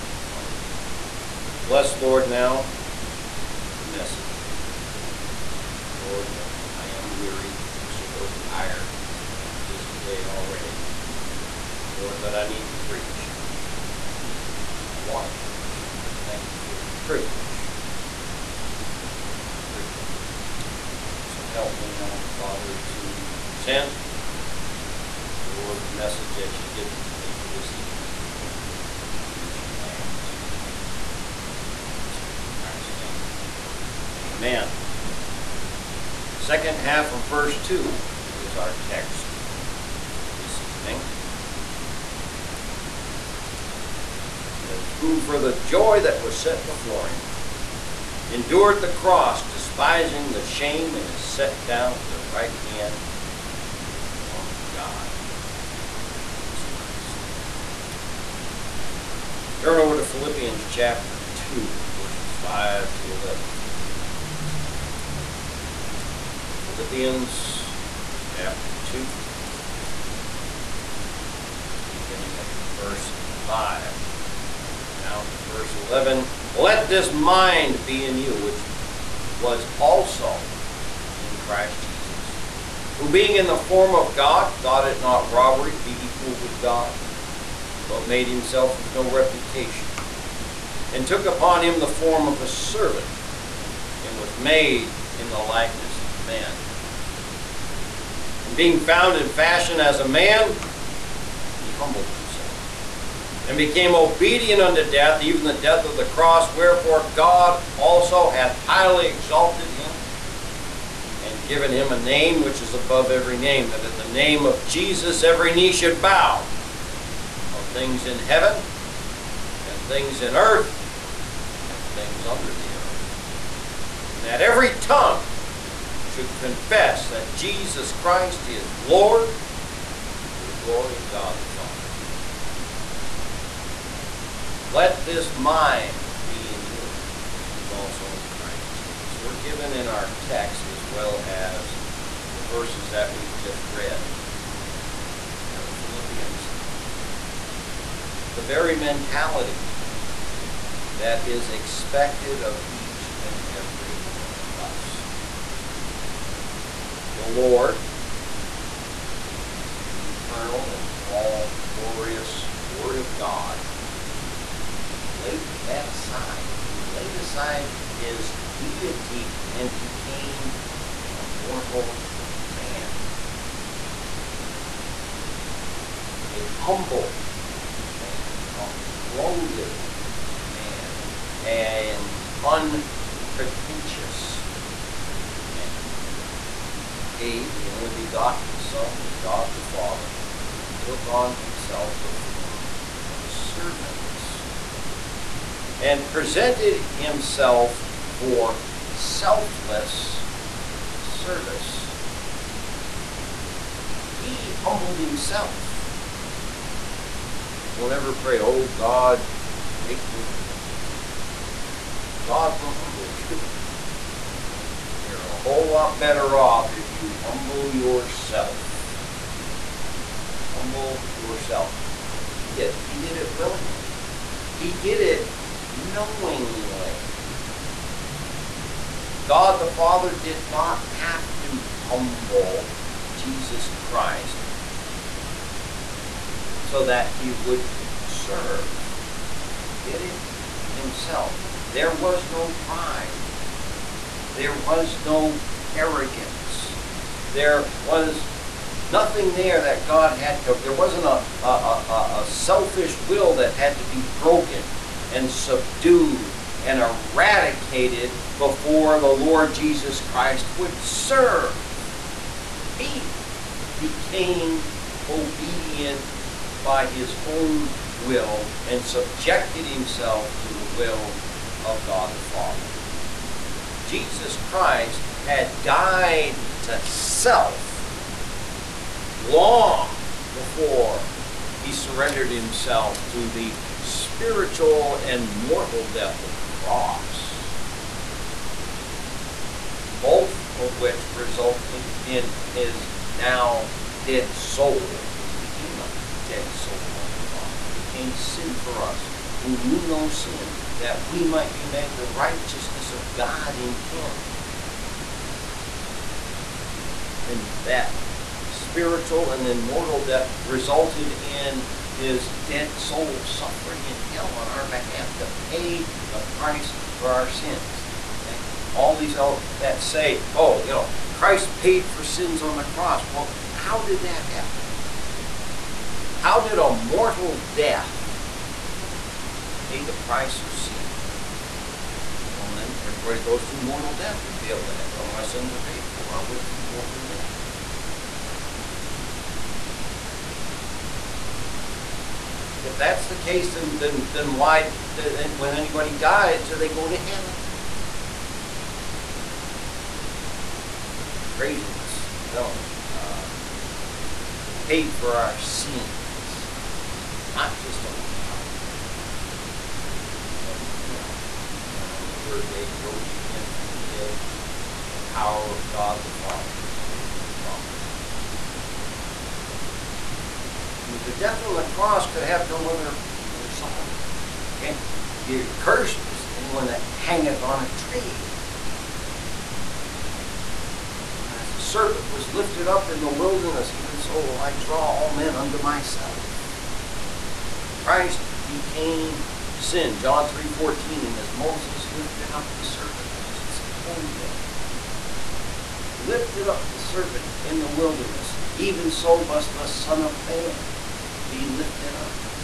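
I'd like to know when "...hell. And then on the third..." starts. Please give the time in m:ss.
6:00.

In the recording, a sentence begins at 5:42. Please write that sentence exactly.
If that's the case, then, then, then why, then, when anybody dies, do they go to hell?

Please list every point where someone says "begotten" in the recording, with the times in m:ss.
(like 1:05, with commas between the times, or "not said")
3:07.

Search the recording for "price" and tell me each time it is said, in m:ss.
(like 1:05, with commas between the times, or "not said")
5:16, 5:29.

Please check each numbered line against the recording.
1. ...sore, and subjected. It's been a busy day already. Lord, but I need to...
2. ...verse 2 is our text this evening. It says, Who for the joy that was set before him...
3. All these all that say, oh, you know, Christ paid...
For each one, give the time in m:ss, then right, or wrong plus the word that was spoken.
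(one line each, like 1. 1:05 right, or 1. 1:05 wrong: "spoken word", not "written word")
1. 0:07 wrong: "tired", not "subjected"
2. 0:37 right
3. 5:18 right.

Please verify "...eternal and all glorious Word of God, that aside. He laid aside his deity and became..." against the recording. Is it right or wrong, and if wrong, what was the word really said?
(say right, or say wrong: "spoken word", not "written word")
right.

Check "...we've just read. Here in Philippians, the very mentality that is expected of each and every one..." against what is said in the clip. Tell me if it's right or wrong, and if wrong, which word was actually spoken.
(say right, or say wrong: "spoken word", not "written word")
right.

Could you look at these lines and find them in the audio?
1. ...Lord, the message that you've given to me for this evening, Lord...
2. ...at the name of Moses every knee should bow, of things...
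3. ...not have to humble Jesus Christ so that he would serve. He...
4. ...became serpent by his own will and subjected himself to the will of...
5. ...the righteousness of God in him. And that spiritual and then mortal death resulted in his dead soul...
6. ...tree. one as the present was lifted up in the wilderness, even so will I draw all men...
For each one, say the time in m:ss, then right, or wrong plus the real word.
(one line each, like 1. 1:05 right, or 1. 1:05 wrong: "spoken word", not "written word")
1. 0:25 right
2. 1:53 wrong: "Jesus", not "Moses"
3. 3:50 right
4. 4:23 wrong: "obedient", not "serpent"
5. 5:01 right
6. 6:17 wrong: "serpent", not "present".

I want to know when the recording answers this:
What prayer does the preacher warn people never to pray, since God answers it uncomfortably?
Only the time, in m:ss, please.
3:28.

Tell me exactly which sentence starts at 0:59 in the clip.
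Turn over to Philippians chapter 2, verses 5 to 11.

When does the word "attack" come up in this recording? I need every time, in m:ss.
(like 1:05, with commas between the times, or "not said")
not said.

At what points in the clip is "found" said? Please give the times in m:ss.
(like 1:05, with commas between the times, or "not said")
1:38.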